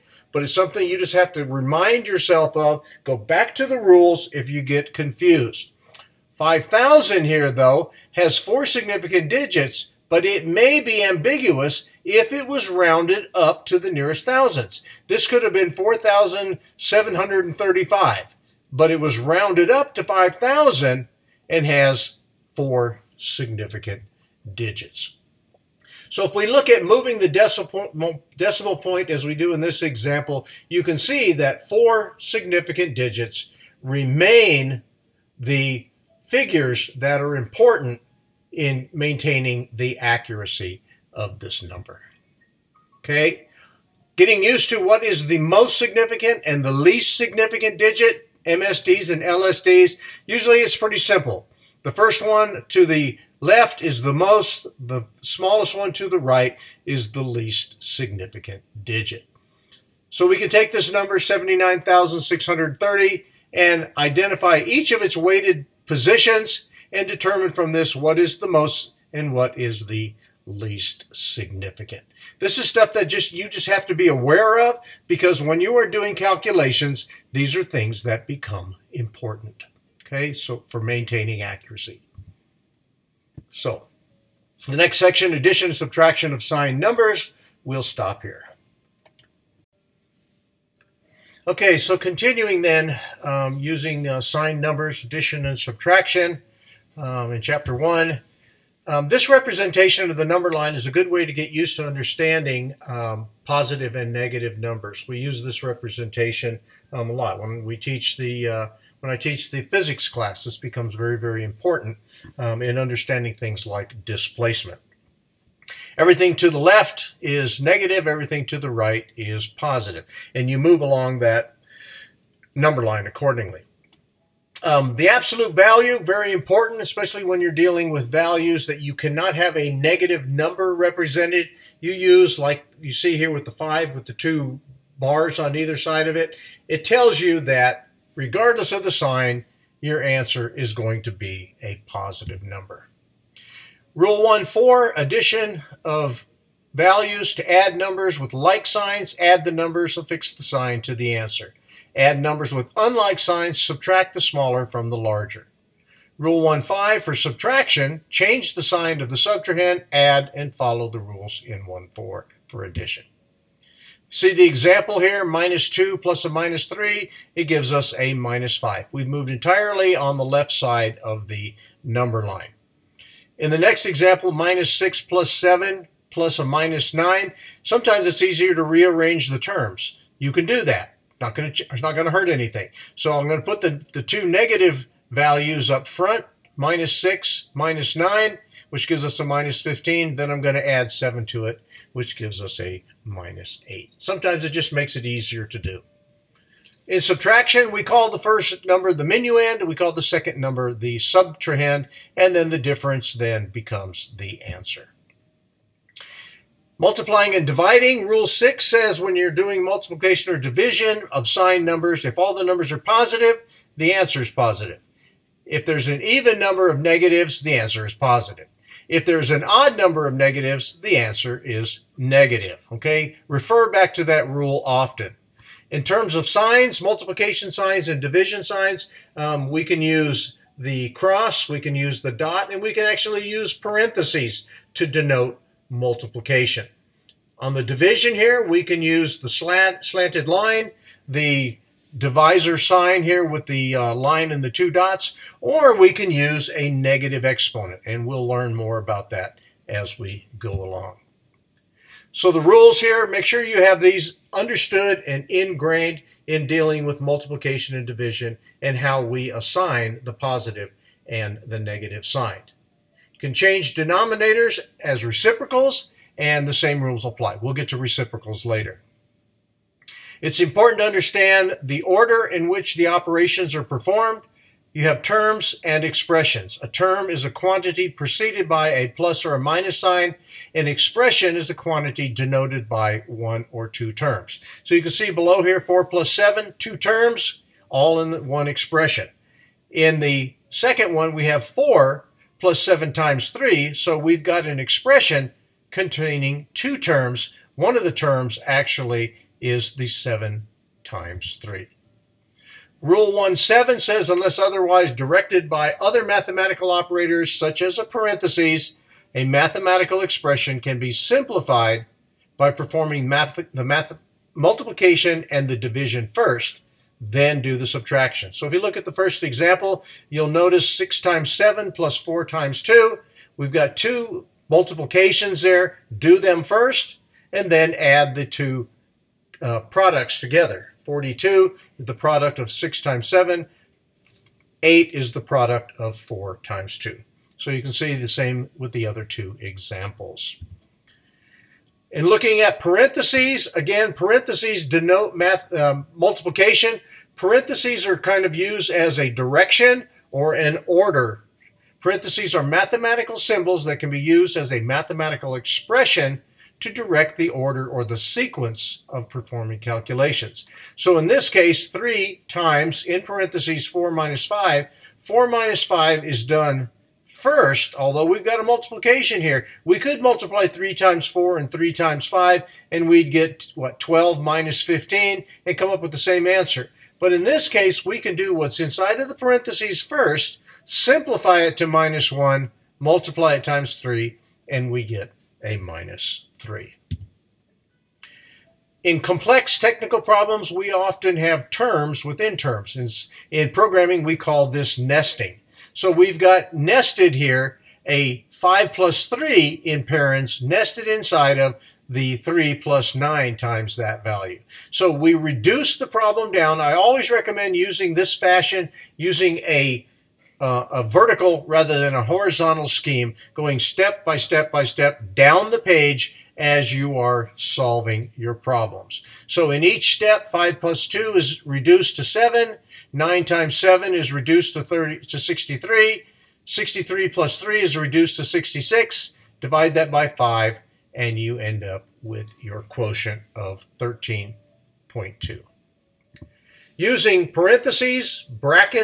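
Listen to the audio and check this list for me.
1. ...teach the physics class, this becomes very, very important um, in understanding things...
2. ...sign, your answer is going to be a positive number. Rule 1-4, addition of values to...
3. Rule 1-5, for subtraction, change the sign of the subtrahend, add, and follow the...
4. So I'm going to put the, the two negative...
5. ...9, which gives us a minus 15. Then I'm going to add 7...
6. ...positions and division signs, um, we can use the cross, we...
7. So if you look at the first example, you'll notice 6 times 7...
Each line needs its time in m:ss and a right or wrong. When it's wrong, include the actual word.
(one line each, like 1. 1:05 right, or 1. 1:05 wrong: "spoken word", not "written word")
1. 1:49 right
2. 2:18 right
3. 2:36 right
4. 3:02 right
5. 3:07 right
6. 3:47 wrong: "signs", not "positions"
7. 5:18 right.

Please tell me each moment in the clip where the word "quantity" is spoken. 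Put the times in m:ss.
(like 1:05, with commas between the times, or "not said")
4:37, 4:41.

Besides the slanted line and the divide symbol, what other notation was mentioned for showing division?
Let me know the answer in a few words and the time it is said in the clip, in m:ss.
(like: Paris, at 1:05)
negative exponent, at 4:06.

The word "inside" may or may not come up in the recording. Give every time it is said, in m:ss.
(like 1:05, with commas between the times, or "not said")
6:18, 6:40.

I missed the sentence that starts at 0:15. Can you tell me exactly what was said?
This could have been 4,735, but it was rounded up to 5,000 and has four significant digits.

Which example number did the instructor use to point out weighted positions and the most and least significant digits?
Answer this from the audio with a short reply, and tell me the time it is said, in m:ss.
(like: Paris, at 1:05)
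79,630, at 1:01.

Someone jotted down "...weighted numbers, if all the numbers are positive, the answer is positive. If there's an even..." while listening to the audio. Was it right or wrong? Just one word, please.
wrong.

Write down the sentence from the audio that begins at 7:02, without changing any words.
9 times 7 is reduced to 30 to 63.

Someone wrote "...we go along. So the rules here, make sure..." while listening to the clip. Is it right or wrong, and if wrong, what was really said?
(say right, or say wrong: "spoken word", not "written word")
right.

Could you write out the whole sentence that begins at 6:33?
In, programming, we call this nesting.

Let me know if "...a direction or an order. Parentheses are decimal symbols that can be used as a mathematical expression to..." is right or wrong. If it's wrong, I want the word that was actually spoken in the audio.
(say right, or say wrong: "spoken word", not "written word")
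wrong: "mathematical", not "decimal".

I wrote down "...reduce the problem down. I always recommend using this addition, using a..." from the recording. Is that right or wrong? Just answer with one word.
wrong.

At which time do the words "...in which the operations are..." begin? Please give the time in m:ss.
4:32.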